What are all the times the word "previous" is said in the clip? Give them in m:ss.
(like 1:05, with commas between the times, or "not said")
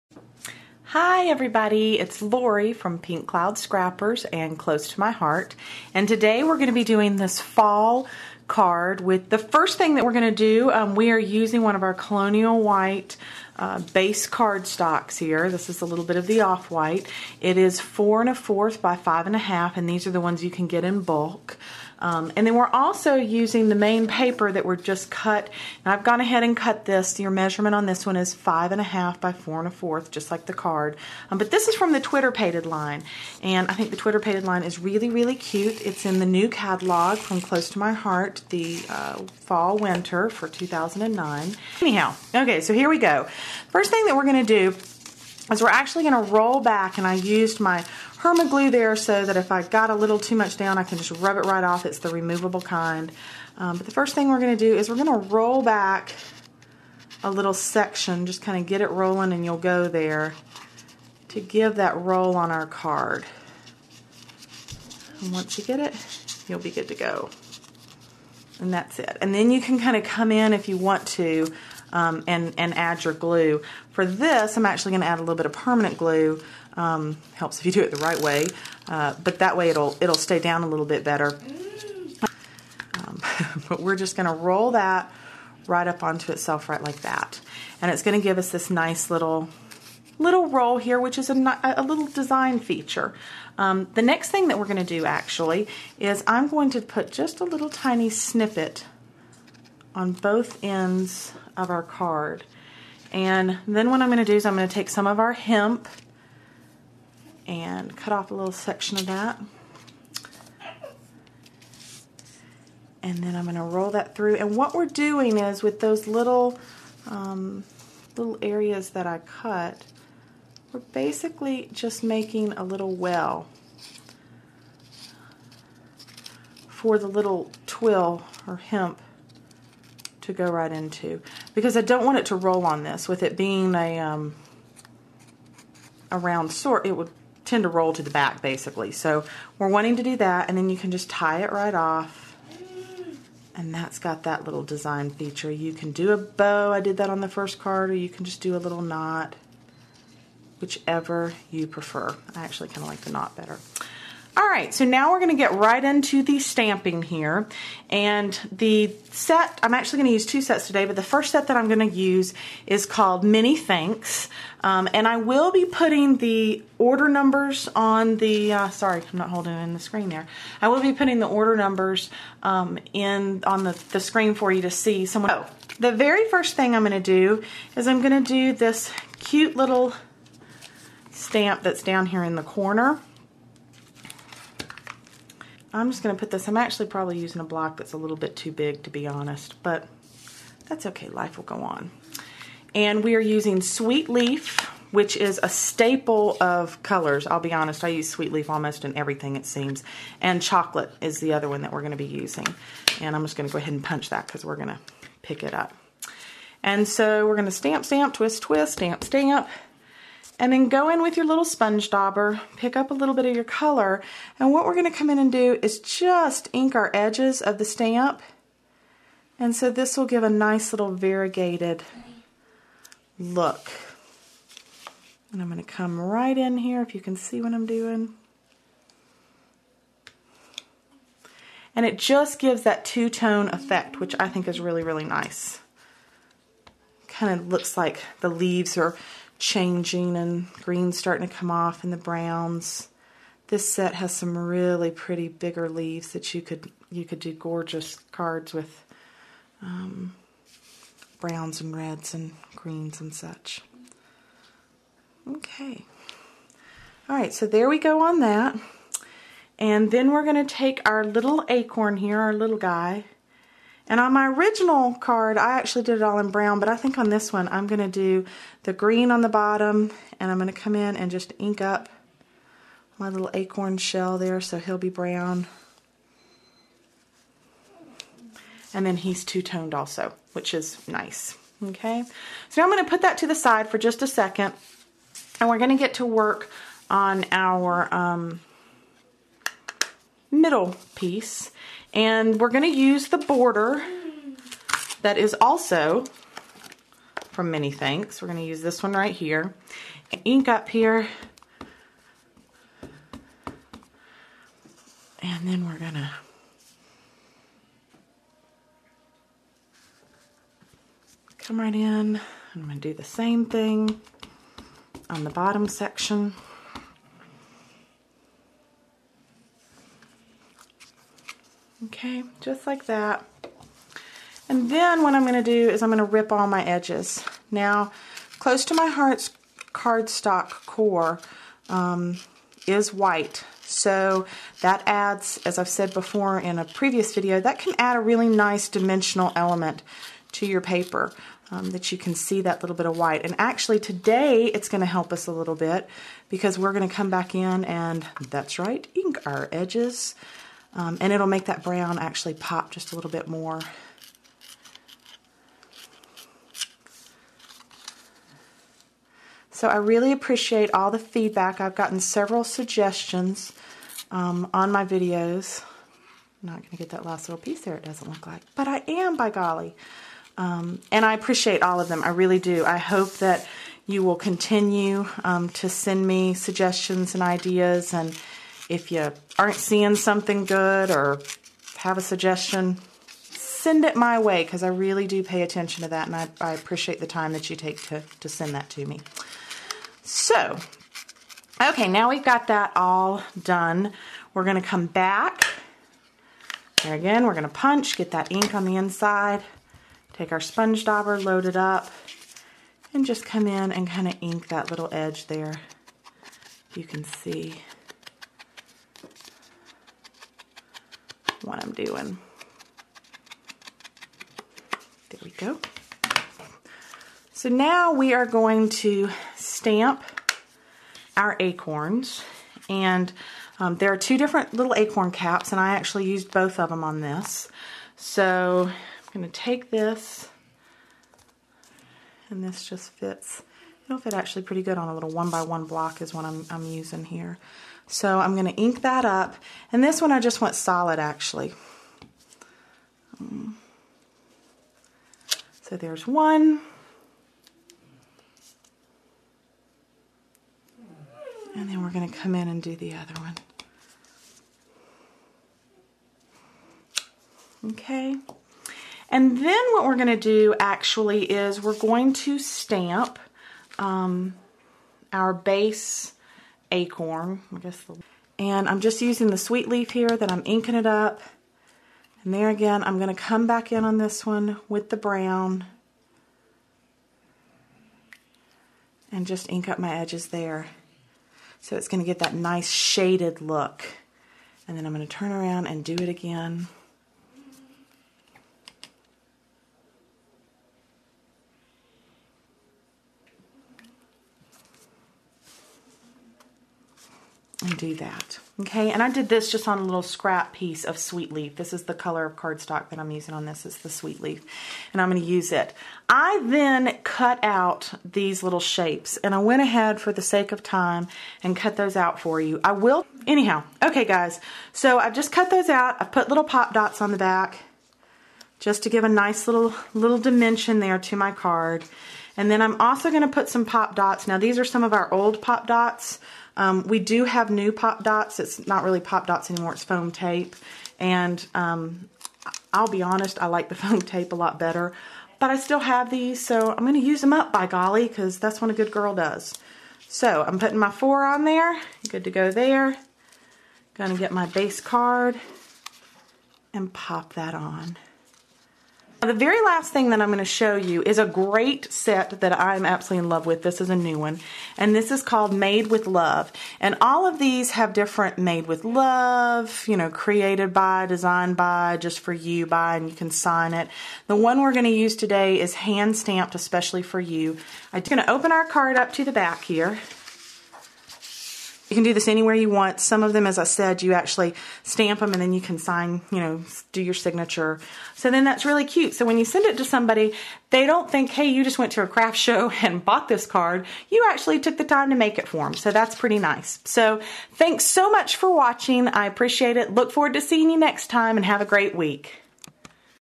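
5:36.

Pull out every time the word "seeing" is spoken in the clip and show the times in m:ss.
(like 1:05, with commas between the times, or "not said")
6:19, 9:50.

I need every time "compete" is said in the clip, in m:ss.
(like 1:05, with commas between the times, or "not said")
not said.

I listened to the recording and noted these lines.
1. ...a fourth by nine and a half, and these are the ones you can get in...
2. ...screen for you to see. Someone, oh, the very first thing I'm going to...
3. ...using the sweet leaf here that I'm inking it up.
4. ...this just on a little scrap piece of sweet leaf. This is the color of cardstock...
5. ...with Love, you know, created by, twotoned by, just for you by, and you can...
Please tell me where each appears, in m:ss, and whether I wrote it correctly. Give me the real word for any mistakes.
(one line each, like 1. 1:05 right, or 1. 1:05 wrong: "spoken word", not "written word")
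1. 0:18 wrong: "five", not "nine"
2. 2:53 right
3. 7:49 right
4. 8:19 right
5. 9:18 wrong: "designed", not "twotoned".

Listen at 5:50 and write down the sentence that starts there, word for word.
Um, and it'll make that brown actually pop just a little bit more.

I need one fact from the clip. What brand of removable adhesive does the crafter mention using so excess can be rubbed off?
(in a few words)
Herma.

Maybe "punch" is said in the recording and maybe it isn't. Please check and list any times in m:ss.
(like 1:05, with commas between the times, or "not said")
3:23, 6:37.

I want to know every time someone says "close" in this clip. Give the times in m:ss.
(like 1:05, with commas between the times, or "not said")
0:04, 0:37, 5:28.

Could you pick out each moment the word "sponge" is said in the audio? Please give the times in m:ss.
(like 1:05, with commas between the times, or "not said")
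3:31, 6:40.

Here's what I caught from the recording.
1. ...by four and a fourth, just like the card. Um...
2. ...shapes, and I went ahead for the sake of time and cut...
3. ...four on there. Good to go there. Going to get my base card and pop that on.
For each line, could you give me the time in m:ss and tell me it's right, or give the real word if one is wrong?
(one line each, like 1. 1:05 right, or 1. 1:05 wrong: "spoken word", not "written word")
1. 0:29 right
2. 8:28 right
3. 9:00 right.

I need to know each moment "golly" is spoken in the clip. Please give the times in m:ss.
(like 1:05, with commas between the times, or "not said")
6:09, 8:57.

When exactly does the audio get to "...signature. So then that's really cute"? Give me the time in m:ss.
9:37.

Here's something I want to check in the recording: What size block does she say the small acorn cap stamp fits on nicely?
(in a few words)
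1 by 1.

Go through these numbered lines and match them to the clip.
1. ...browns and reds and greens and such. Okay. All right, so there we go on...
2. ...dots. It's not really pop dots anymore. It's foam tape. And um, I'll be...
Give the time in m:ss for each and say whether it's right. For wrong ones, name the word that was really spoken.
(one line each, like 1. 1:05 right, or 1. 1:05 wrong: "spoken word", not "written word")
1. 4:11 right
2. 8:48 right.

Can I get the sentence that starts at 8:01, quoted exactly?
So it's going to get that nice shaded look.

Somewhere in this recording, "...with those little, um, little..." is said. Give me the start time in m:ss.
1:55.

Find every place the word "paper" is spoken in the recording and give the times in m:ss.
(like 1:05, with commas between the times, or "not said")
0:24, 5:40.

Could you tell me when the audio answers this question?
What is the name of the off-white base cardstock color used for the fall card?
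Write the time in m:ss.
0:11.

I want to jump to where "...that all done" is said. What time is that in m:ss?
6:32.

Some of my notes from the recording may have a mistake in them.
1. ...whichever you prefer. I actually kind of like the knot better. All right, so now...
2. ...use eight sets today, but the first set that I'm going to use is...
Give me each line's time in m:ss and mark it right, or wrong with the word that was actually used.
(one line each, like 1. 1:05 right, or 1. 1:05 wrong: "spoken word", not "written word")
1. 2:30 right
2. 2:40 wrong: "two", not "eight".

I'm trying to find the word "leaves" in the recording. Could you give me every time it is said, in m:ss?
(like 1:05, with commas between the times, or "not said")
3:58, 4:05.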